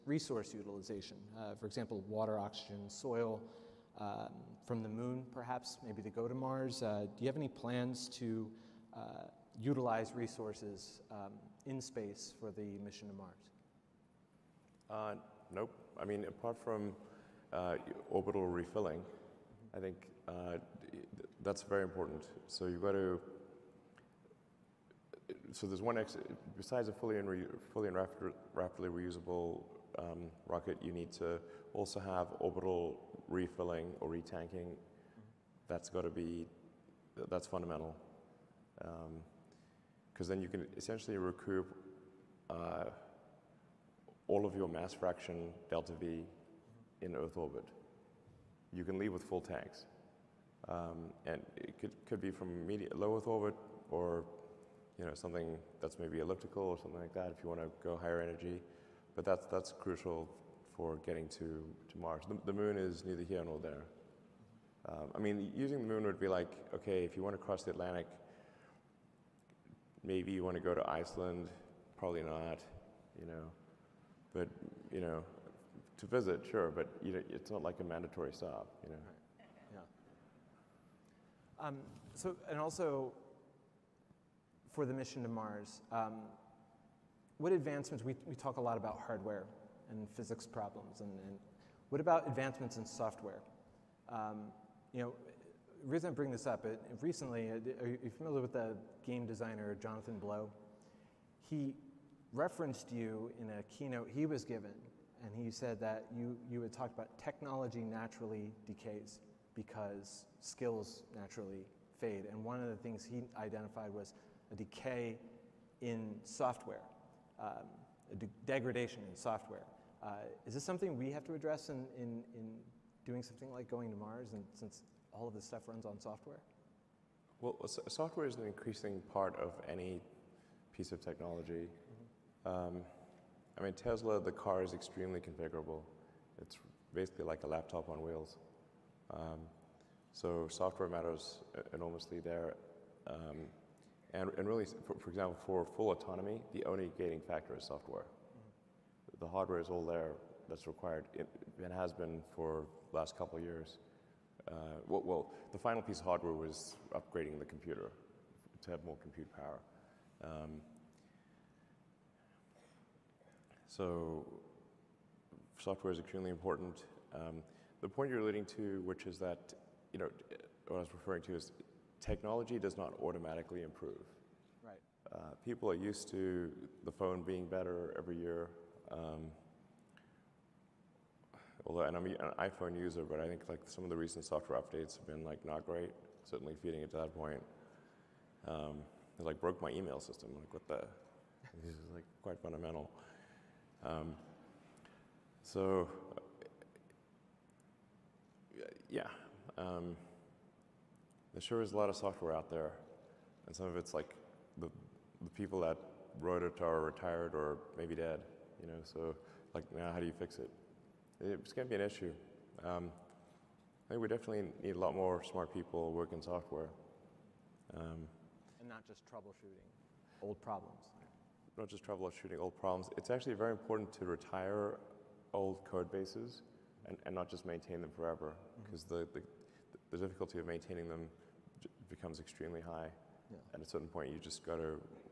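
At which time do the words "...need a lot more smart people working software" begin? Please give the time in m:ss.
3:34.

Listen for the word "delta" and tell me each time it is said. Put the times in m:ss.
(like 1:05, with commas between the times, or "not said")
0:45.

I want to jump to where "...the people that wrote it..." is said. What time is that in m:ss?
3:25.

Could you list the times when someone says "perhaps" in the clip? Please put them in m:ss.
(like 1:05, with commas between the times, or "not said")
0:05.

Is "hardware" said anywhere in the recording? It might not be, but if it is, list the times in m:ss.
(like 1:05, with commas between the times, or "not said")
1:29, 2:29, 2:36.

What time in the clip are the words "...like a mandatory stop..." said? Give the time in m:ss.
1:17.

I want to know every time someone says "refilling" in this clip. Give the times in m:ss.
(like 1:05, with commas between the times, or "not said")
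0:18, 0:33.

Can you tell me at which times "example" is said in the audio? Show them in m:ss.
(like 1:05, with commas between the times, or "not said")
0:01, 2:25.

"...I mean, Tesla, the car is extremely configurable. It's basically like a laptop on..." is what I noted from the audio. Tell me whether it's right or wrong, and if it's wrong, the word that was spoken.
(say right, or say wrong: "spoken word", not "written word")
right.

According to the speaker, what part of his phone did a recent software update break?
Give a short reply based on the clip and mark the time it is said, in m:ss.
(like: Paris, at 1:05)
Email system, at 3:09.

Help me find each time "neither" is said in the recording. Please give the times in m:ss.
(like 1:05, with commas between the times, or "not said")
1:03.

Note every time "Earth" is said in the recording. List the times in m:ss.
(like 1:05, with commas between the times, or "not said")
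0:47, 0:53.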